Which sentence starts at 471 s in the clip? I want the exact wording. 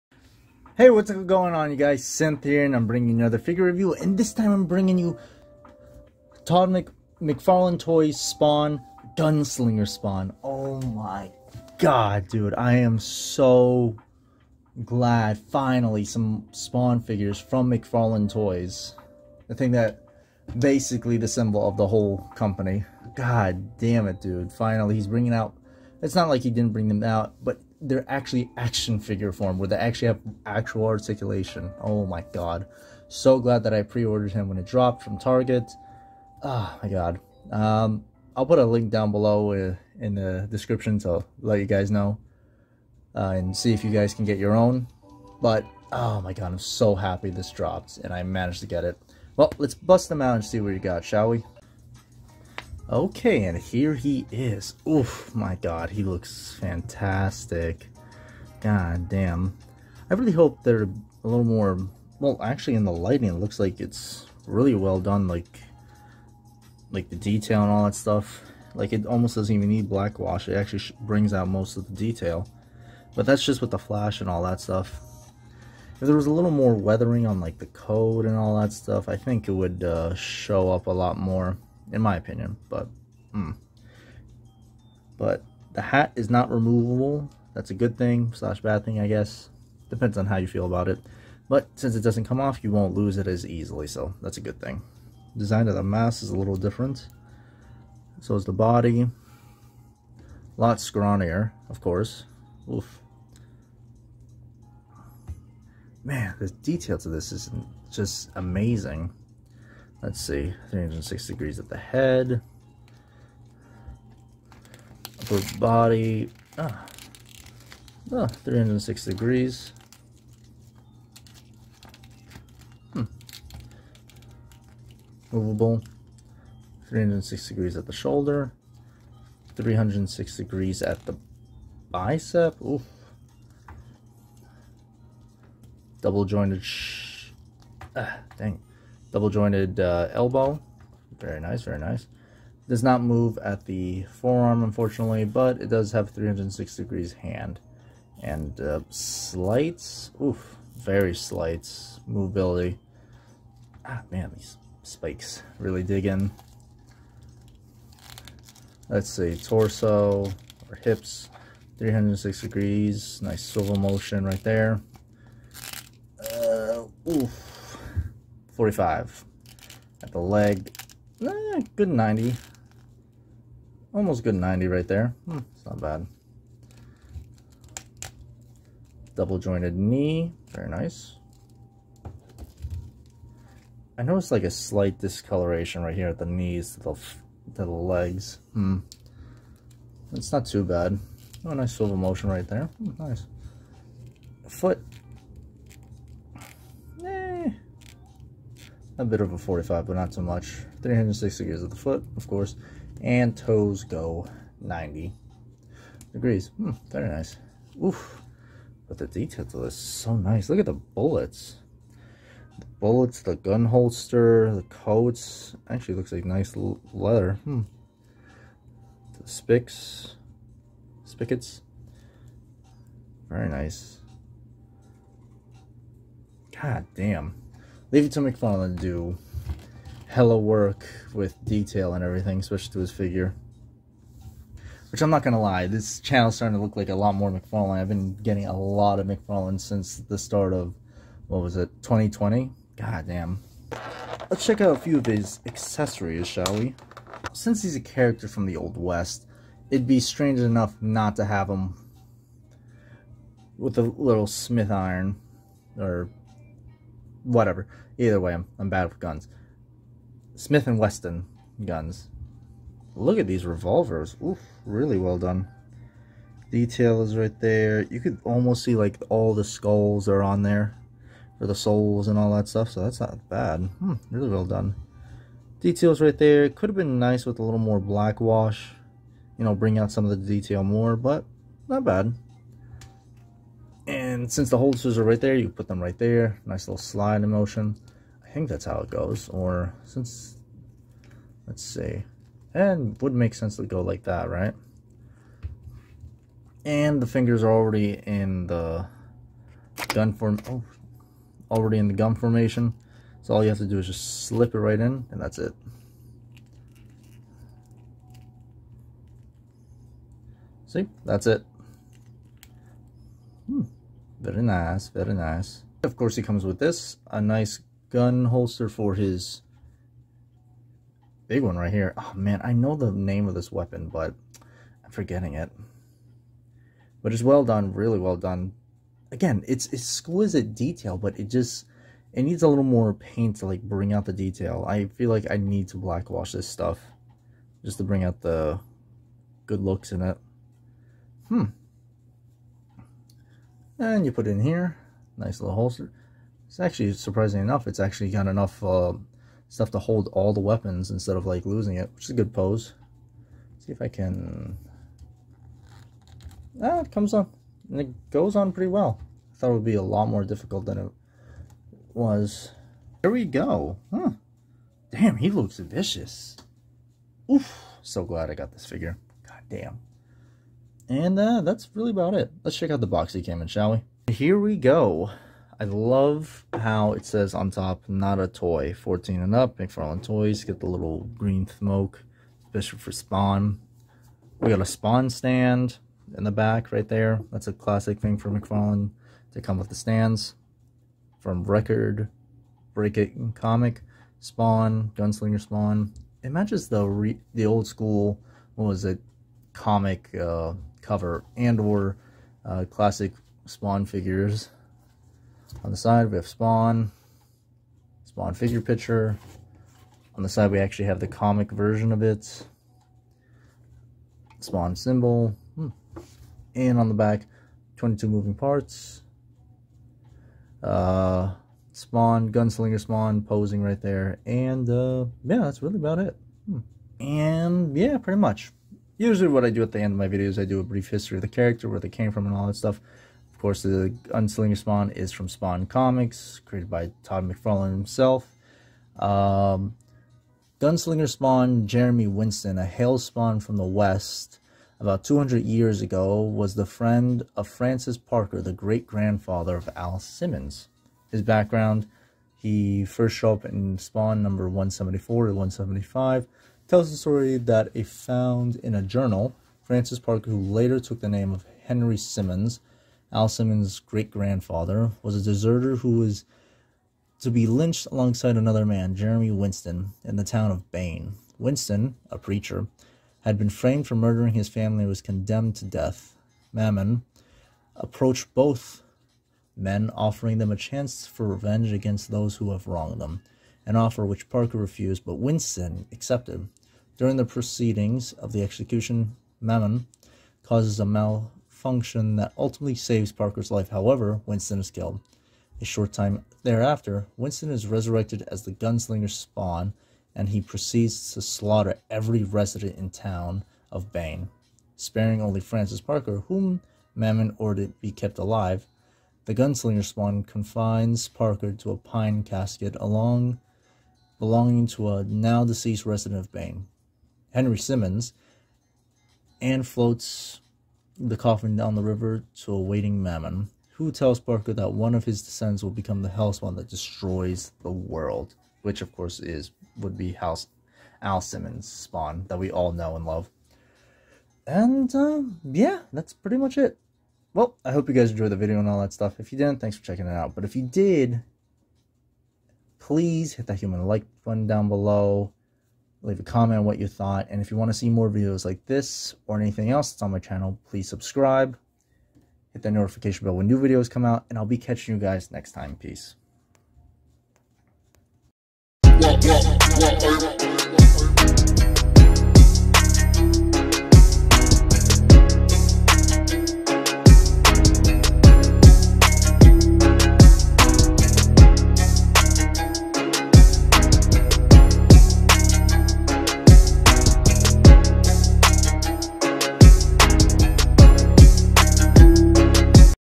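Winston, a preacher, had been framed for murdering his family and was condemned to death.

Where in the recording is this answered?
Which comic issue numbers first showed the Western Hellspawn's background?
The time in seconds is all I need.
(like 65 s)
454 s.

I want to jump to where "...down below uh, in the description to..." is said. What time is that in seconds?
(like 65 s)
38 s.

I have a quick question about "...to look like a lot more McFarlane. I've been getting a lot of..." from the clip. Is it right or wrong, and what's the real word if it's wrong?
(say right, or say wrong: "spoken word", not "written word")
right.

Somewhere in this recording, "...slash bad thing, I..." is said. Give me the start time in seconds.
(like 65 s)
88 s.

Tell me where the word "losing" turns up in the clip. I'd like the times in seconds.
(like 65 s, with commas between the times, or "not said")
351 s.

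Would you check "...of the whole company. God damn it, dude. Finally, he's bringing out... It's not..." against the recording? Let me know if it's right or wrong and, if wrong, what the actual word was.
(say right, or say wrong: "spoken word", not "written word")
right.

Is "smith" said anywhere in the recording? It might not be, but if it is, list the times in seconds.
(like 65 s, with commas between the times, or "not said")
254 s, 260 s.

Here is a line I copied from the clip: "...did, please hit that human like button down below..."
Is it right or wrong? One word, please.
right.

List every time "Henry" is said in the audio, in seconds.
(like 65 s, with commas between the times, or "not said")
461 s, 517 s.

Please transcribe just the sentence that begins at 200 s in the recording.
360 degrees of the foot, of course, and toes go 90 degrees.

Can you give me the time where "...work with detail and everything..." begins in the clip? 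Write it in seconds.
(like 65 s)
230 s.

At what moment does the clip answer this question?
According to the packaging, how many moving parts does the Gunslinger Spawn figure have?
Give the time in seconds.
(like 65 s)
417 s.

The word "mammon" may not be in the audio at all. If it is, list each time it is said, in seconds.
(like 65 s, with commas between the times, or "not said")
476 s, 489 s, 506 s, 523 s.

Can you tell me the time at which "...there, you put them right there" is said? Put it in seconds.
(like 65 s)
285 s.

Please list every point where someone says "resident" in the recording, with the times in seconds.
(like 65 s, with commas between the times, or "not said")
502 s, 515 s.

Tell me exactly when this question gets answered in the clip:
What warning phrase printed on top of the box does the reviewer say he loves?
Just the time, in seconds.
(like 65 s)
377 s.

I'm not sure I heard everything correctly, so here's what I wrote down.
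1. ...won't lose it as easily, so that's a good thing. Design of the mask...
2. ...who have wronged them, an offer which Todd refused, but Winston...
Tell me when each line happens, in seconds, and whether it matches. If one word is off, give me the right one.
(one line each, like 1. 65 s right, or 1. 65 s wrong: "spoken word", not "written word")
1. 92 s right
2. 482 s wrong: "Parker", not "Todd".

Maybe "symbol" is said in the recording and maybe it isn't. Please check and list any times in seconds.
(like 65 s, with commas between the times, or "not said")
21 s, 414 s.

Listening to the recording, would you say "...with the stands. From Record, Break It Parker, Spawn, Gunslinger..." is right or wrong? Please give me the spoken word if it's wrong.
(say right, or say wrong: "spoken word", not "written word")
wrong: "Comic", not "Parker".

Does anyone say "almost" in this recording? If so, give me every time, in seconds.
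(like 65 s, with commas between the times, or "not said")
69 s, 173 s, 268 s.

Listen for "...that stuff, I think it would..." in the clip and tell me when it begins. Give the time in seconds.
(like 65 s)
78 s.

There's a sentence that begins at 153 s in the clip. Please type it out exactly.
Ah, man, these spikes really dig in.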